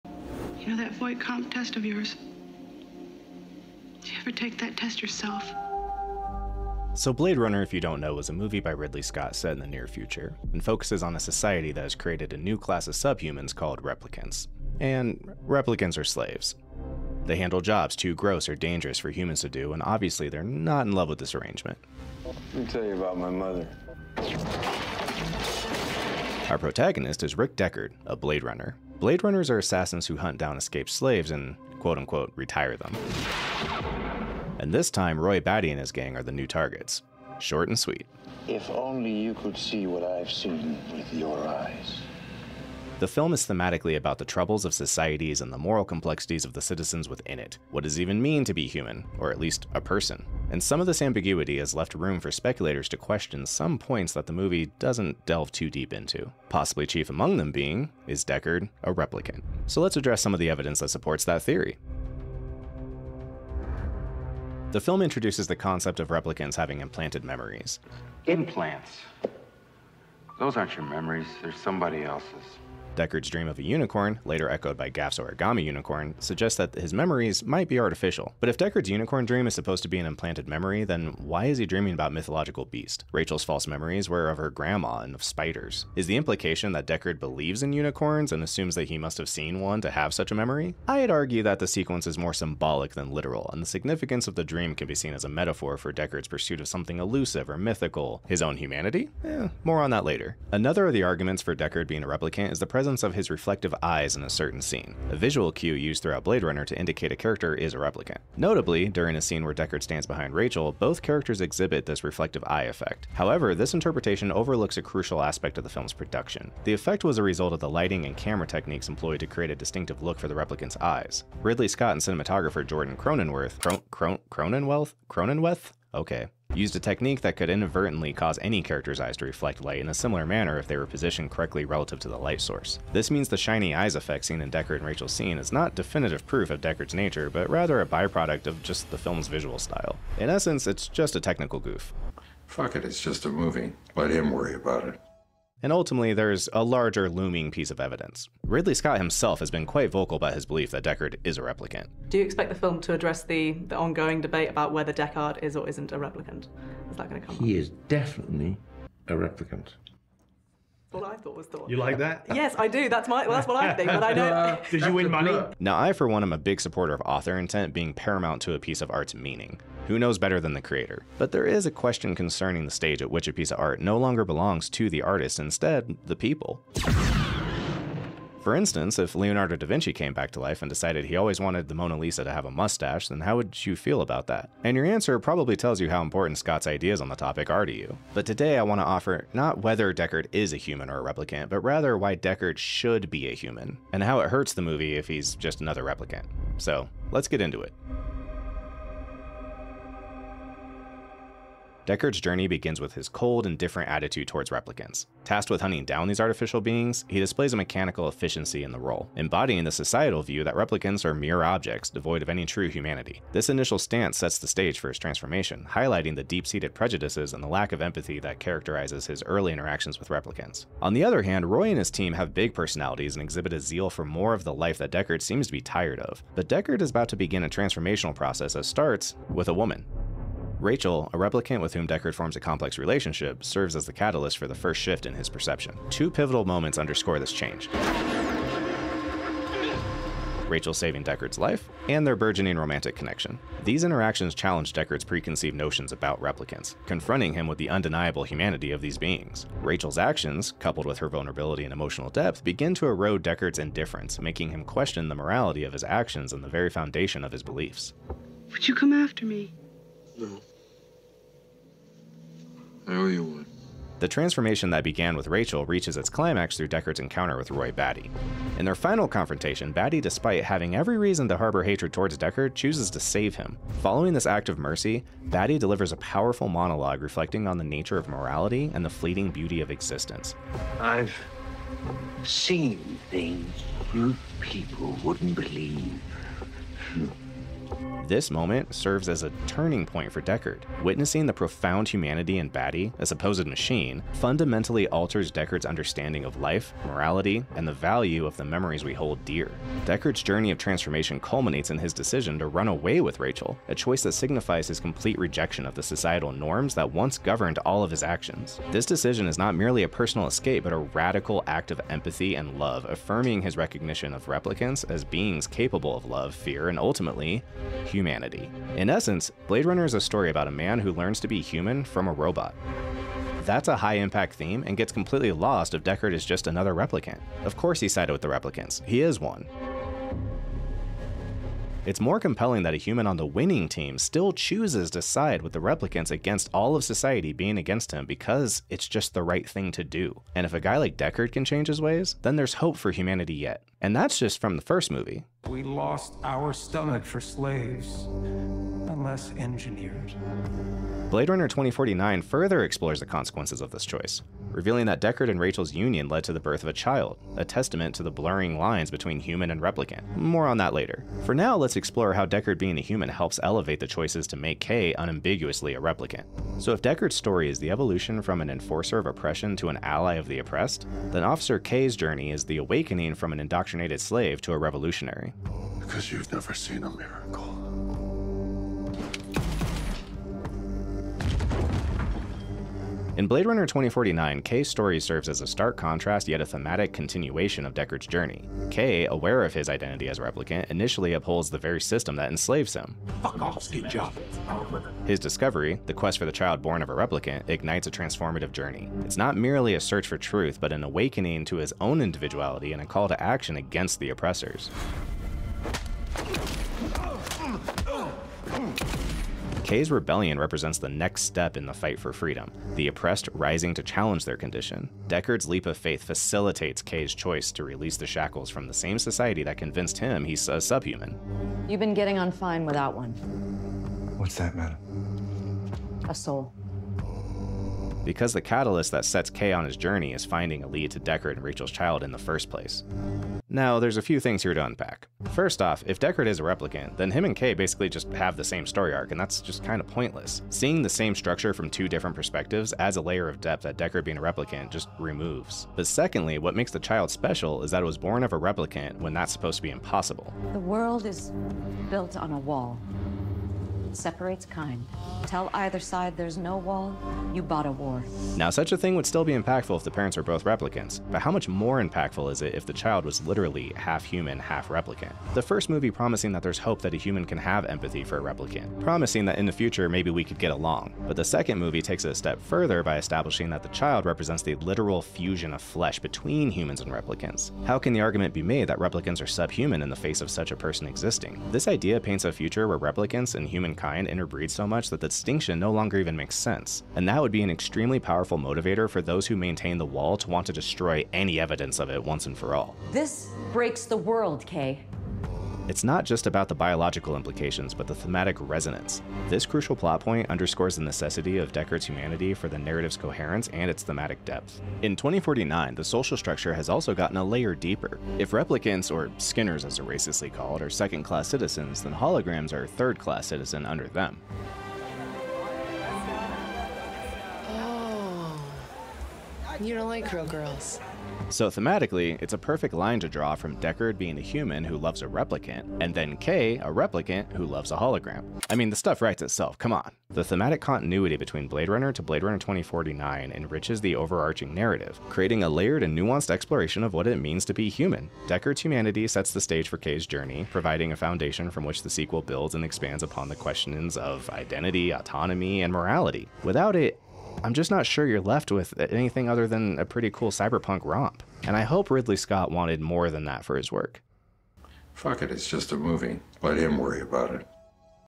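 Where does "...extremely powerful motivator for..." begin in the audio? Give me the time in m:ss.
8:07.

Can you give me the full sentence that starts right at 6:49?
Kay's rebellion represents the next step in the fight for freedom, the oppressed rising to challenge their condition.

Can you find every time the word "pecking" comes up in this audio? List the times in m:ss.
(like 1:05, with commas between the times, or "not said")
not said.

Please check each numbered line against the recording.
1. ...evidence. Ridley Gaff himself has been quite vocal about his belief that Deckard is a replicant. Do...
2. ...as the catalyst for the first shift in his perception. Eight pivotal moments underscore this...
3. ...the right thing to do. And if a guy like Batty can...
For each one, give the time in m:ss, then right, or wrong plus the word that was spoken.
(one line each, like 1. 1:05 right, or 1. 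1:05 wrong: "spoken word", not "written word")
1. 2:27 wrong: "Scott", not "Gaff"
2. 3:53 wrong: "Two", not "Eight"
3. 5:39 wrong: "Deckard", not "Batty".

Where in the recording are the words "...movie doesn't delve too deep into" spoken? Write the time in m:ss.
0:54.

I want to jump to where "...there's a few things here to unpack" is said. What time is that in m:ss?
7:13.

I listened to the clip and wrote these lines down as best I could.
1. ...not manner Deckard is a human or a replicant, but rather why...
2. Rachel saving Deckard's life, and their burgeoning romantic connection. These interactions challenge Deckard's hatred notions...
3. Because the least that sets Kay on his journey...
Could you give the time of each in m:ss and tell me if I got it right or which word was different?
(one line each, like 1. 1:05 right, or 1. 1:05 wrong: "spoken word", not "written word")
1. 3:09 wrong: "whether", not "manner"
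2. 4:00 wrong: "preconceived", not "hatred"
3. 7:08 wrong: "catalyst", not "least".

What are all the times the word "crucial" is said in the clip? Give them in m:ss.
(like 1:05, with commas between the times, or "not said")
1:54, 8:19.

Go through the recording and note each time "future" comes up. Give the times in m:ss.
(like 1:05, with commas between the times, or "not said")
0:09, 7:49, 8:02.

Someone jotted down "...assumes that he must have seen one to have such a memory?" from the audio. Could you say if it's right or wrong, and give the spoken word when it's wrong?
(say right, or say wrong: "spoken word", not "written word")
right.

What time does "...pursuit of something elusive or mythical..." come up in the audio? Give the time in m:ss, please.
1:36.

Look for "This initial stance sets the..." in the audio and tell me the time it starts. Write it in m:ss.
3:33.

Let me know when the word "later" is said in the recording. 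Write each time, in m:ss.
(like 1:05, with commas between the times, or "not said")
1:14, 1:40, 6:00.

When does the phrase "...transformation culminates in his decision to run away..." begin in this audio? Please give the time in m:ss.
5:00.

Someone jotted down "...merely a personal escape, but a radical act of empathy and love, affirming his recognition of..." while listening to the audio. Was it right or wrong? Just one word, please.
right.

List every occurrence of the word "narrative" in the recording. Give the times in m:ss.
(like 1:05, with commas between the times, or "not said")
8:22, 8:54.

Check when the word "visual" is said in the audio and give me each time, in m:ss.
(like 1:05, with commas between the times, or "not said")
1:45, 2:19.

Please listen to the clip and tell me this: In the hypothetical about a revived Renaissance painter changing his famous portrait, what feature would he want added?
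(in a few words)
a mustache.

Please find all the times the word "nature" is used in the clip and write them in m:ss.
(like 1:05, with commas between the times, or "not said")
2:16, 4:37.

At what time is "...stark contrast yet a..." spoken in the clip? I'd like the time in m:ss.
6:25.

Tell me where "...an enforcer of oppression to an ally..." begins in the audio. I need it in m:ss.
6:08.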